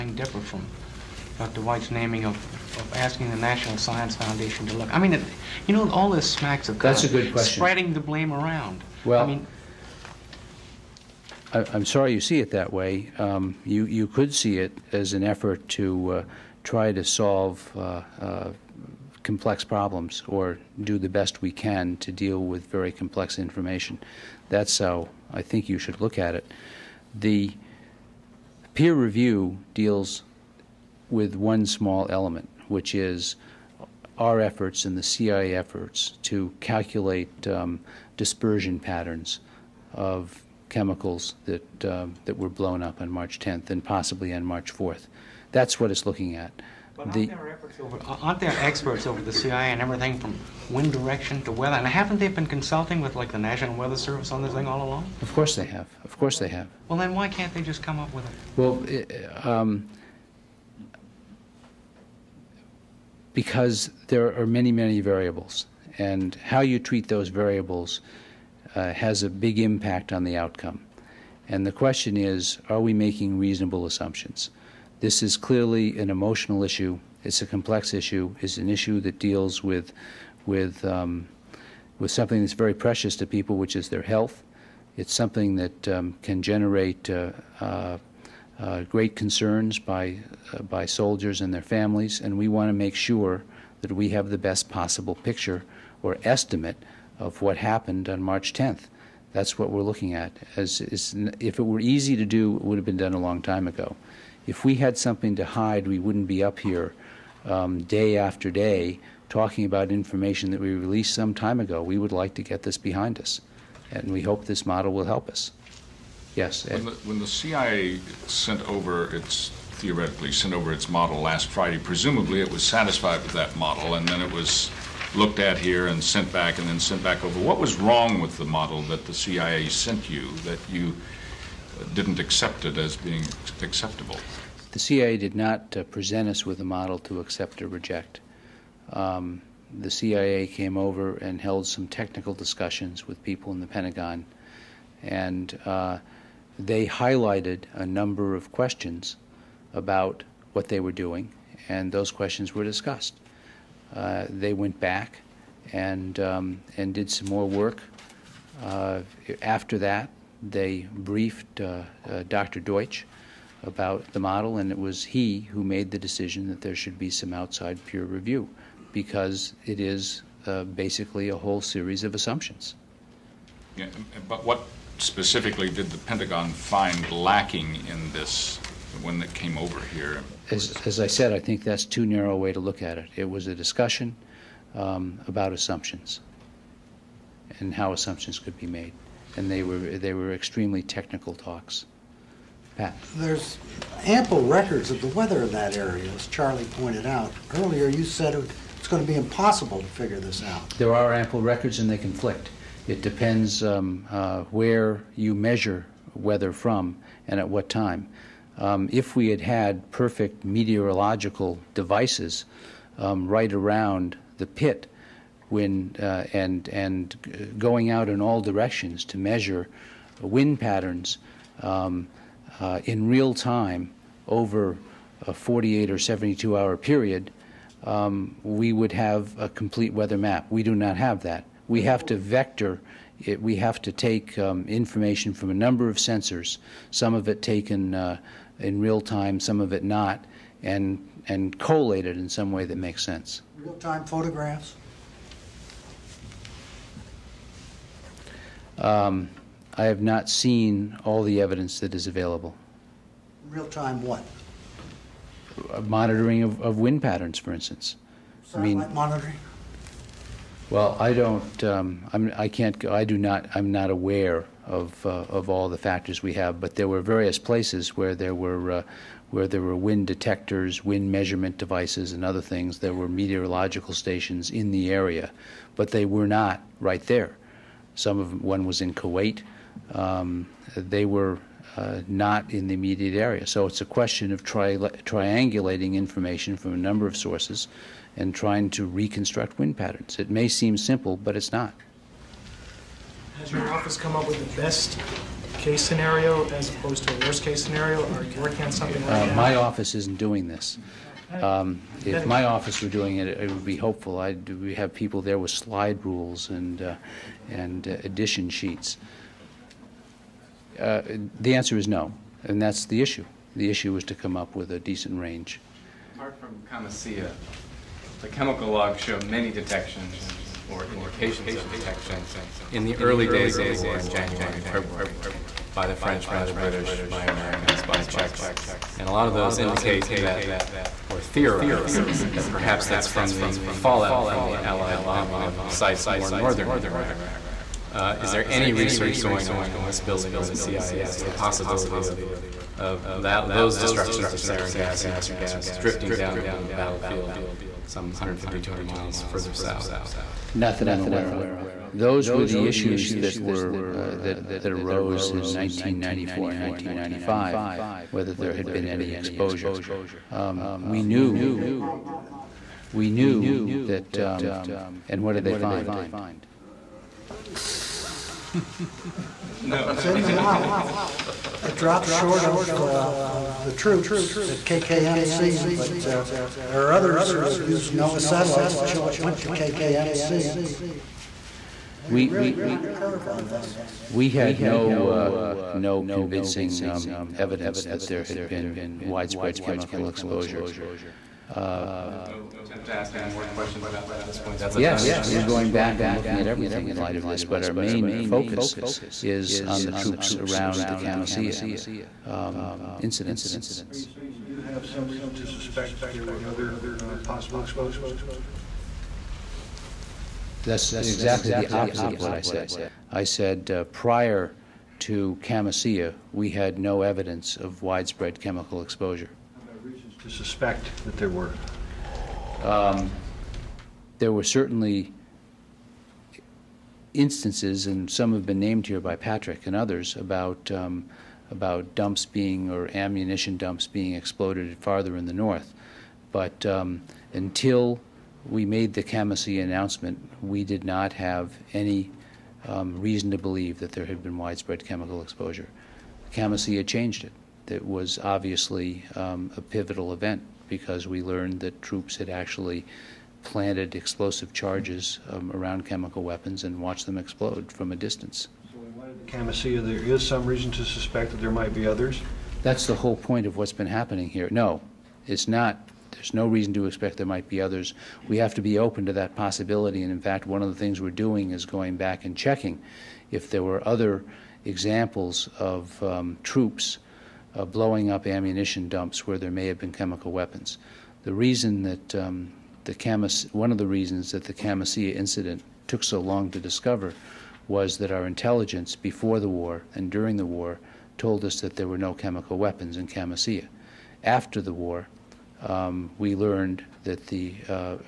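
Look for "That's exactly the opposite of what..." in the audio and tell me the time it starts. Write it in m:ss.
6:50.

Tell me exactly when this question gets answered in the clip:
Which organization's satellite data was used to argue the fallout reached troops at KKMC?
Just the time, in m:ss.
6:17.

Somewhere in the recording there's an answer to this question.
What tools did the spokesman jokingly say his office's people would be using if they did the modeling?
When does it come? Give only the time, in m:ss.
5:05.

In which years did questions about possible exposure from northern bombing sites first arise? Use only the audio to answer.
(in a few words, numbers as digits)
1994 and 1995.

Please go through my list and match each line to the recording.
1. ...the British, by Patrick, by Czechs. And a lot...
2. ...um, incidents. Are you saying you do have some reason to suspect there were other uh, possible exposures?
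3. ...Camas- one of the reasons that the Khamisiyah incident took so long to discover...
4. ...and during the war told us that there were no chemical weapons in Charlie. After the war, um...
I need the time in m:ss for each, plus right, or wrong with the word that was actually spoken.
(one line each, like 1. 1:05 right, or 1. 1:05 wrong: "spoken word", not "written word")
1. 5:26 wrong: "Americans", not "Patrick"
2. 6:42 right
3. 8:02 right
4. 8:09 wrong: "Khamisiyah", not "Charlie".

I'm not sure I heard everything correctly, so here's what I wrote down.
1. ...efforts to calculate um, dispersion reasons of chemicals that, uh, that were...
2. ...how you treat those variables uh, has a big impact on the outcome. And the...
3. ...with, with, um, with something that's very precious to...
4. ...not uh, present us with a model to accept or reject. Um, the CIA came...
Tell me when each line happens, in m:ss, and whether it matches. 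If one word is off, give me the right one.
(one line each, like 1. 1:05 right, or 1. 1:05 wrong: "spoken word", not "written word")
1. 0:35 wrong: "patterns", not "reasons"
2. 1:06 right
3. 1:19 right
4. 2:15 right.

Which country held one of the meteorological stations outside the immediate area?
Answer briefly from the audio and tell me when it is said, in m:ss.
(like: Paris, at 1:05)
Kuwait, at 4:38.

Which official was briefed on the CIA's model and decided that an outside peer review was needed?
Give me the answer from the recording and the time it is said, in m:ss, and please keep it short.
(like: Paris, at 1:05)
Dr. Deutch, at 2:42.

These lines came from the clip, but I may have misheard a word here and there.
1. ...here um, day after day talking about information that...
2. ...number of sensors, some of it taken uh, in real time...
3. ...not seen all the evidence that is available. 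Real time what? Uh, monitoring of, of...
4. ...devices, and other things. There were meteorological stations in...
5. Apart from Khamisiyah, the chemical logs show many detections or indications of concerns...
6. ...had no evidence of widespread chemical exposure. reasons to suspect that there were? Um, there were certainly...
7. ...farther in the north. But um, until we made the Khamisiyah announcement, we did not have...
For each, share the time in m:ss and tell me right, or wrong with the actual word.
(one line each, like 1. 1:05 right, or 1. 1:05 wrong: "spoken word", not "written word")
1. 1:46 right
2. 3:55 right
3. 4:10 right
4. 4:31 right
5. 5:16 wrong: "detections", not "concerns"
6. 6:56 right
7. 7:14 right.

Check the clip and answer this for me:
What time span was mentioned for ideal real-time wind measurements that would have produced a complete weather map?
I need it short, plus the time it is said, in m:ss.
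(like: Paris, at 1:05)
48 or 72 hours, at 3:45.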